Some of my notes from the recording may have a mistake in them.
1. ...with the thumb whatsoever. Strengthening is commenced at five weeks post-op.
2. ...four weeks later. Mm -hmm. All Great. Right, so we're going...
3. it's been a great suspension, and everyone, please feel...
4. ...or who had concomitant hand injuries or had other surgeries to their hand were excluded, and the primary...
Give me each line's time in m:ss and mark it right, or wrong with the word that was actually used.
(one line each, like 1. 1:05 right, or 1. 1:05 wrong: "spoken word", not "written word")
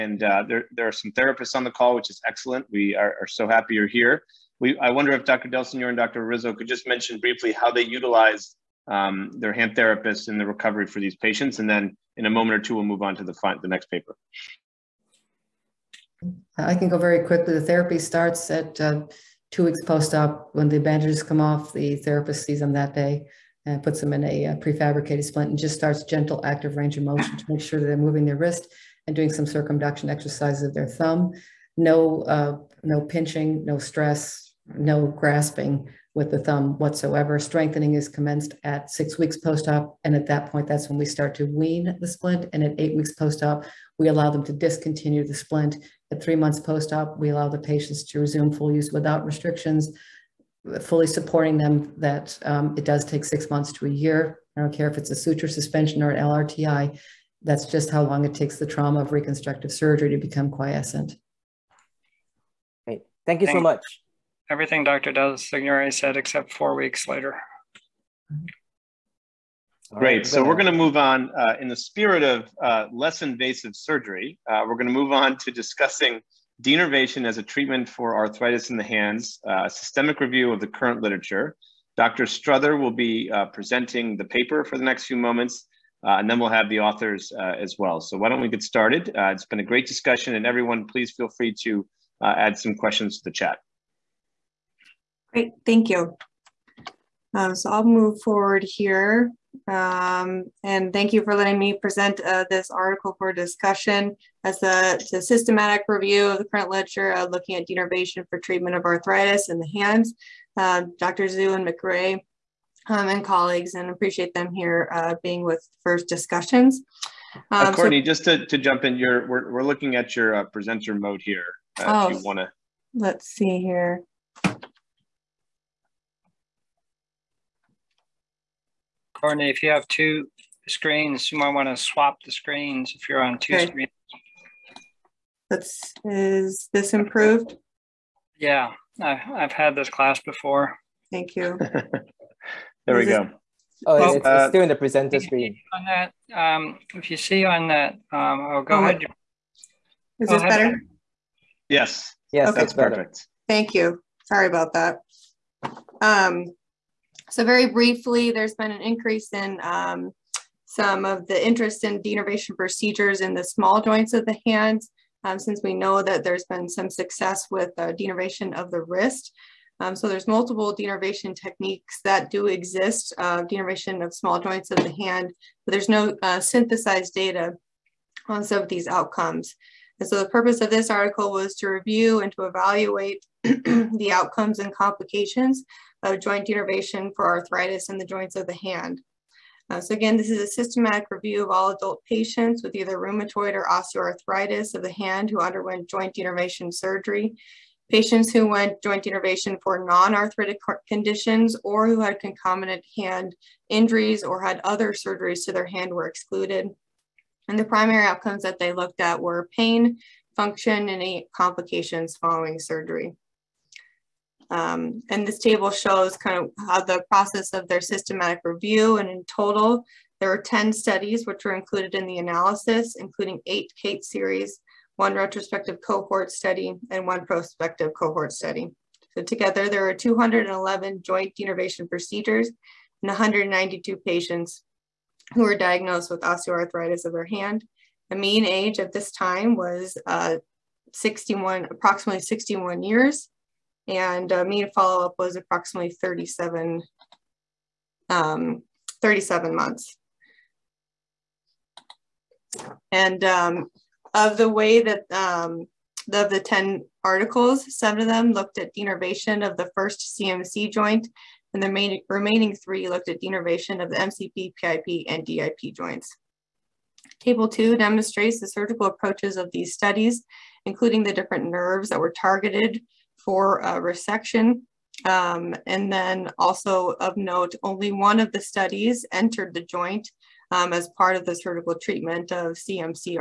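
1. 0:36 wrong: "six", not "five"
2. 1:06 right
3. 1:29 wrong: "discussion", not "suspension"
4. 3:21 right.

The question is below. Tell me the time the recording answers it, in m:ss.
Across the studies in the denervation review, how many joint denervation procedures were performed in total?
3:49.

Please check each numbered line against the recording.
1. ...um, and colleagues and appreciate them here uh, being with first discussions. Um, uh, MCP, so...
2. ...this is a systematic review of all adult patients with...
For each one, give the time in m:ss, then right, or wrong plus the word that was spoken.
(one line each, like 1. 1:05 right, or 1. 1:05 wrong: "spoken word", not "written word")
1. 1:52 wrong: "Courtney", not "MCP"
2. 3:10 right.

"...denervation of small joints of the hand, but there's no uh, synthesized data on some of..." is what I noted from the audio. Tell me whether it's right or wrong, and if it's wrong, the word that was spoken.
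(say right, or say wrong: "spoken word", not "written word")
right.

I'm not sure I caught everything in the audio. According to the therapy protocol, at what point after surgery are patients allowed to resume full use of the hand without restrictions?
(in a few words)
3 months.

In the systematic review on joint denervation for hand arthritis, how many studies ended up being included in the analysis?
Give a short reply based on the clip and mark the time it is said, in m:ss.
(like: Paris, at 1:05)
10, at 3:40.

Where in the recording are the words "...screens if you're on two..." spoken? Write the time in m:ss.
2:12.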